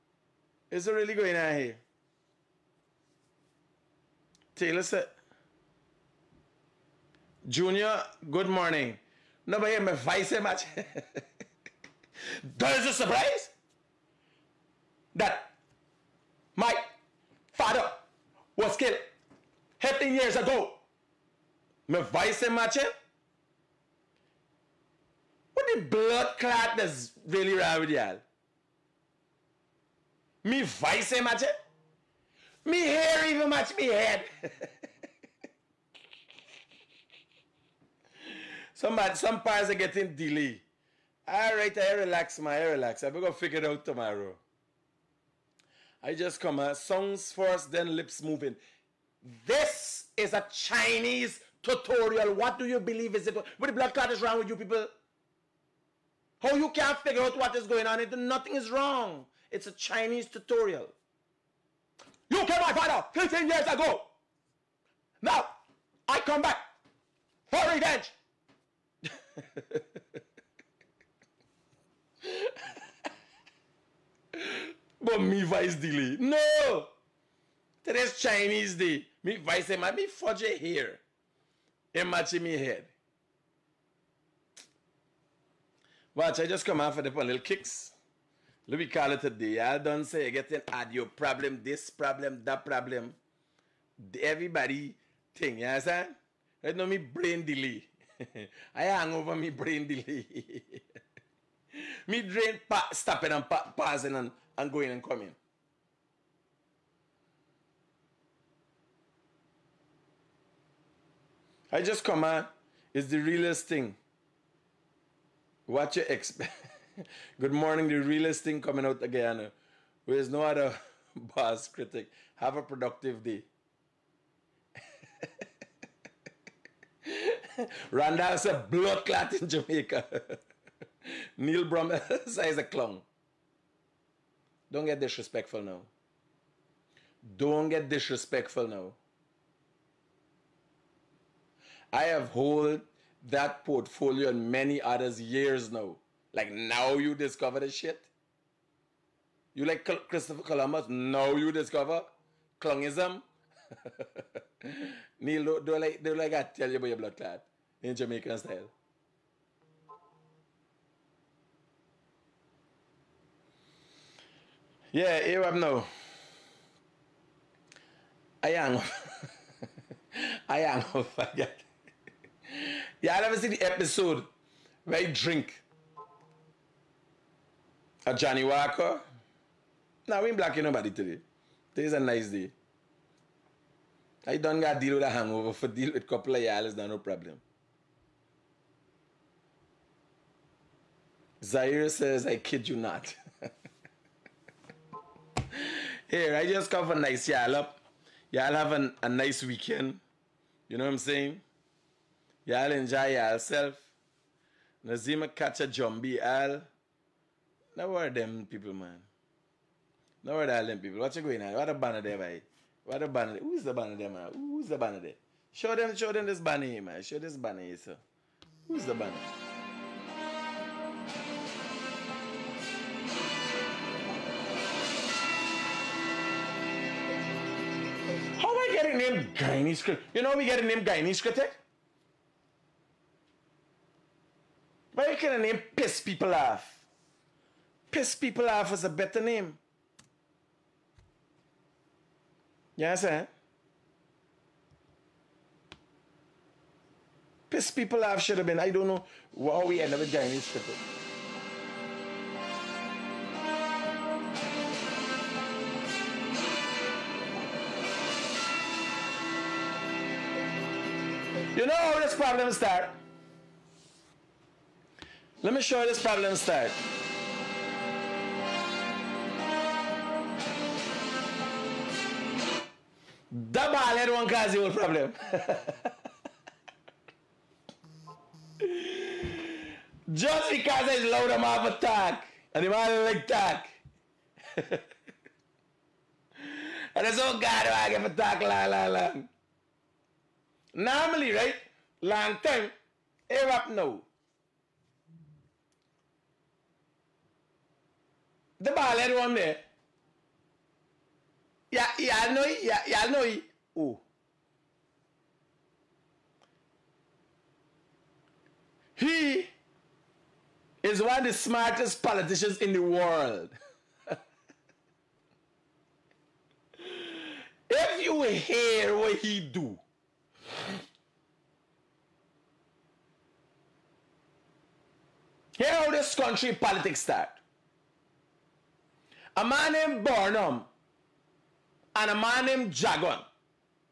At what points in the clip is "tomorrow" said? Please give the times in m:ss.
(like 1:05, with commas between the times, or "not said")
0:43.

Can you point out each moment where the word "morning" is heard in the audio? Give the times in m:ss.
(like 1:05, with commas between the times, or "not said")
0:08, 1:57.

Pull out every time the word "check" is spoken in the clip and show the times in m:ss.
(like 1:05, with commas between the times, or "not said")
not said.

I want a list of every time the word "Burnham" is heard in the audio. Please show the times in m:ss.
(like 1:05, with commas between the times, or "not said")
5:30.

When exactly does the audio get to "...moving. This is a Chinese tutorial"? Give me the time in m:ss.
0:48.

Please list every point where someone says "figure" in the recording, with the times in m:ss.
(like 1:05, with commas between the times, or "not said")
0:43, 0:56.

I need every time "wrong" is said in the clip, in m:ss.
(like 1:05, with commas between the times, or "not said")
0:27, 0:54, 0:58.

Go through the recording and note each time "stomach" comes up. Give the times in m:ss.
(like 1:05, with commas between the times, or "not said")
not said.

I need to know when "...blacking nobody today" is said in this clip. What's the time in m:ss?
3:00.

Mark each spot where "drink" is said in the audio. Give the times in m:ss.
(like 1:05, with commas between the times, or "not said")
2:55.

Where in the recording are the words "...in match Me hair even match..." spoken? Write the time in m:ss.
0:31.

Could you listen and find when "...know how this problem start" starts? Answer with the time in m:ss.
4:21.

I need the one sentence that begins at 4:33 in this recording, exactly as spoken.
That ball head one cause the whole problem.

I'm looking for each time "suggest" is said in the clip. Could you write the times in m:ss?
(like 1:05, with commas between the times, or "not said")
not said.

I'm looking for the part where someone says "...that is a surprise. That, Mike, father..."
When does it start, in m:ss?
0:12.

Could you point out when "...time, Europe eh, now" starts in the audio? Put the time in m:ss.
4:52.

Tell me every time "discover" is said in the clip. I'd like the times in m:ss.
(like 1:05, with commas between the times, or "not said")
2:27, 2:31.